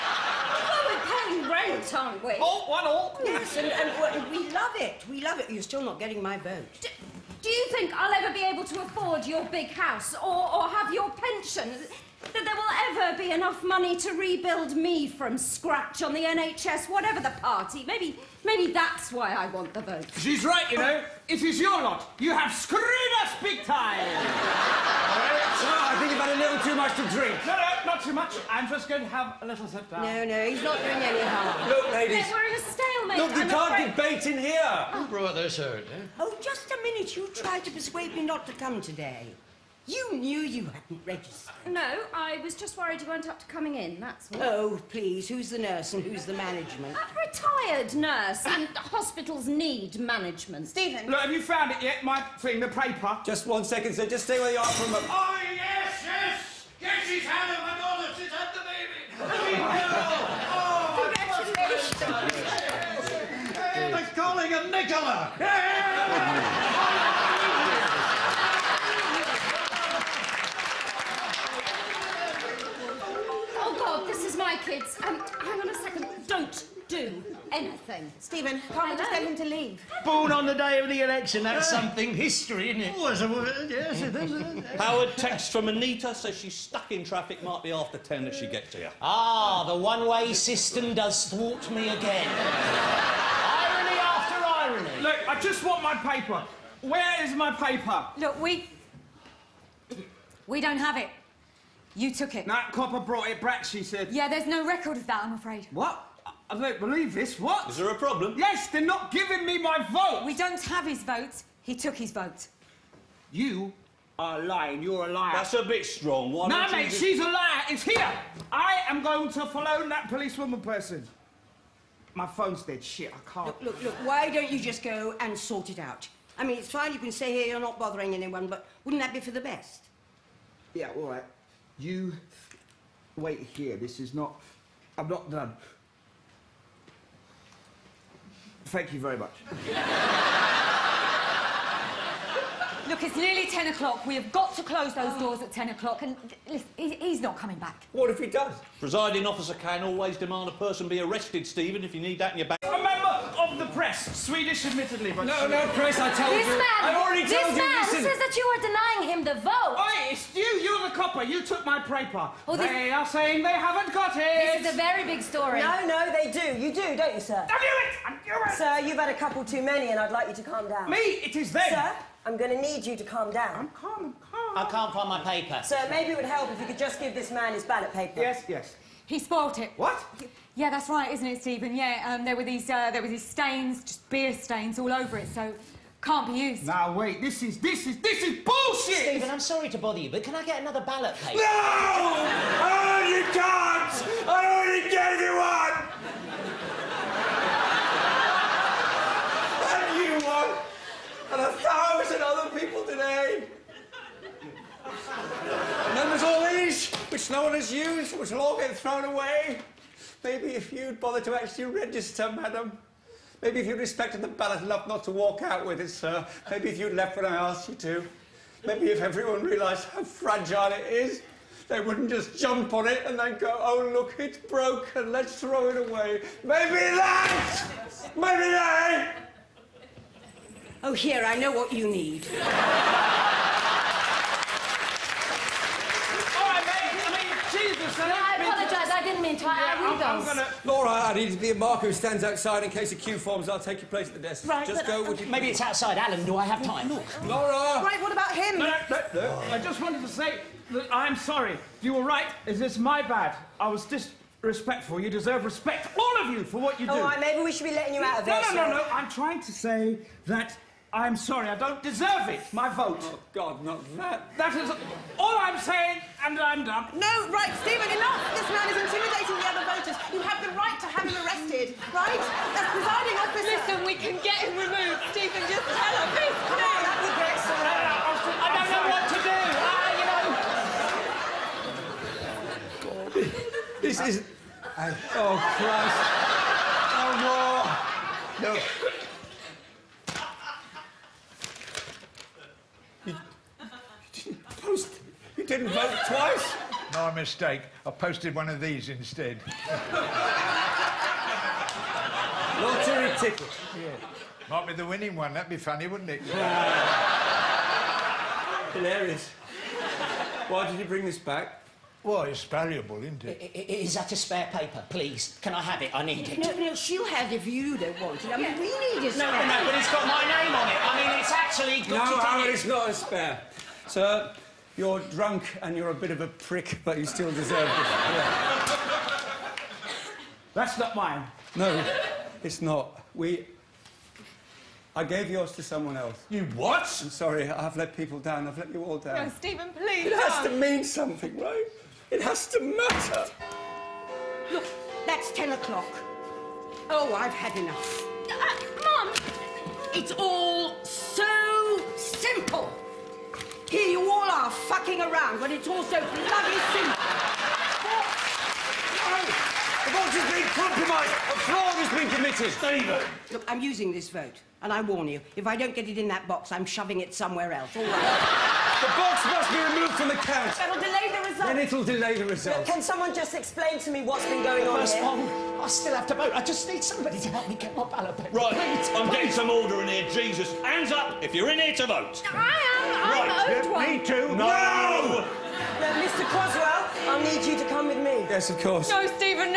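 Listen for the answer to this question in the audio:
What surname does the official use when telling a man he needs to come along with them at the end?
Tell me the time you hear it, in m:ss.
6:26.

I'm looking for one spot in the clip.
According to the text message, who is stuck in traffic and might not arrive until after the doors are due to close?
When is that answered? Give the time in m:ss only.
1:25.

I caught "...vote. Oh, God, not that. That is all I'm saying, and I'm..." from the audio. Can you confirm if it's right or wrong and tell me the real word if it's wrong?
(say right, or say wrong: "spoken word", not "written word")
right.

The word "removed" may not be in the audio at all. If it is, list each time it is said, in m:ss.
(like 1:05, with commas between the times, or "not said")
4:34, 6:09.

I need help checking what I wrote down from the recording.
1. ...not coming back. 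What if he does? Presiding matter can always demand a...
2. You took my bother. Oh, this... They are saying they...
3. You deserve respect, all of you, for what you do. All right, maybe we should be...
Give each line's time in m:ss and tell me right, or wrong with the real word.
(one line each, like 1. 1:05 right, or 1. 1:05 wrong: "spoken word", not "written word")
1. 2:27 wrong: "officer", not "matter"
2. 2:41 wrong: "paper", not "bother"
3. 4:14 right.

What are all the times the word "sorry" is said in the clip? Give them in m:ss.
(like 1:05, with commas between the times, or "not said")
3:09, 4:11, 4:21, 5:37.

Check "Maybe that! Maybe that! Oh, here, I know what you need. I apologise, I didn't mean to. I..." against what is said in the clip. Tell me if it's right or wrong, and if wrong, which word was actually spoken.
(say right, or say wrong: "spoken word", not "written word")
right.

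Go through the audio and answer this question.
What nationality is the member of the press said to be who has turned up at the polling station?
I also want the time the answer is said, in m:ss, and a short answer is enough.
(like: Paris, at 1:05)
Swedish, at 2:34.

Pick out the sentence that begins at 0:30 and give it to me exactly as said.
No, no, he's not doing any harm.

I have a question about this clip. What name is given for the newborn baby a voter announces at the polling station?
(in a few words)
Nicola.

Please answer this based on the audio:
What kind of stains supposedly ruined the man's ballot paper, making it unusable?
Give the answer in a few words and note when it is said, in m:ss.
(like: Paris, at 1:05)
Beer stains, at 3:04.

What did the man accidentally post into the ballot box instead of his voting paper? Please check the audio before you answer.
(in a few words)
Lottery ticket.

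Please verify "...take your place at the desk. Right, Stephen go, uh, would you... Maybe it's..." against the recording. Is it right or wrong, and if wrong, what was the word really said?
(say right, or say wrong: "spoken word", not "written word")
wrong: "Just", not "Stephen".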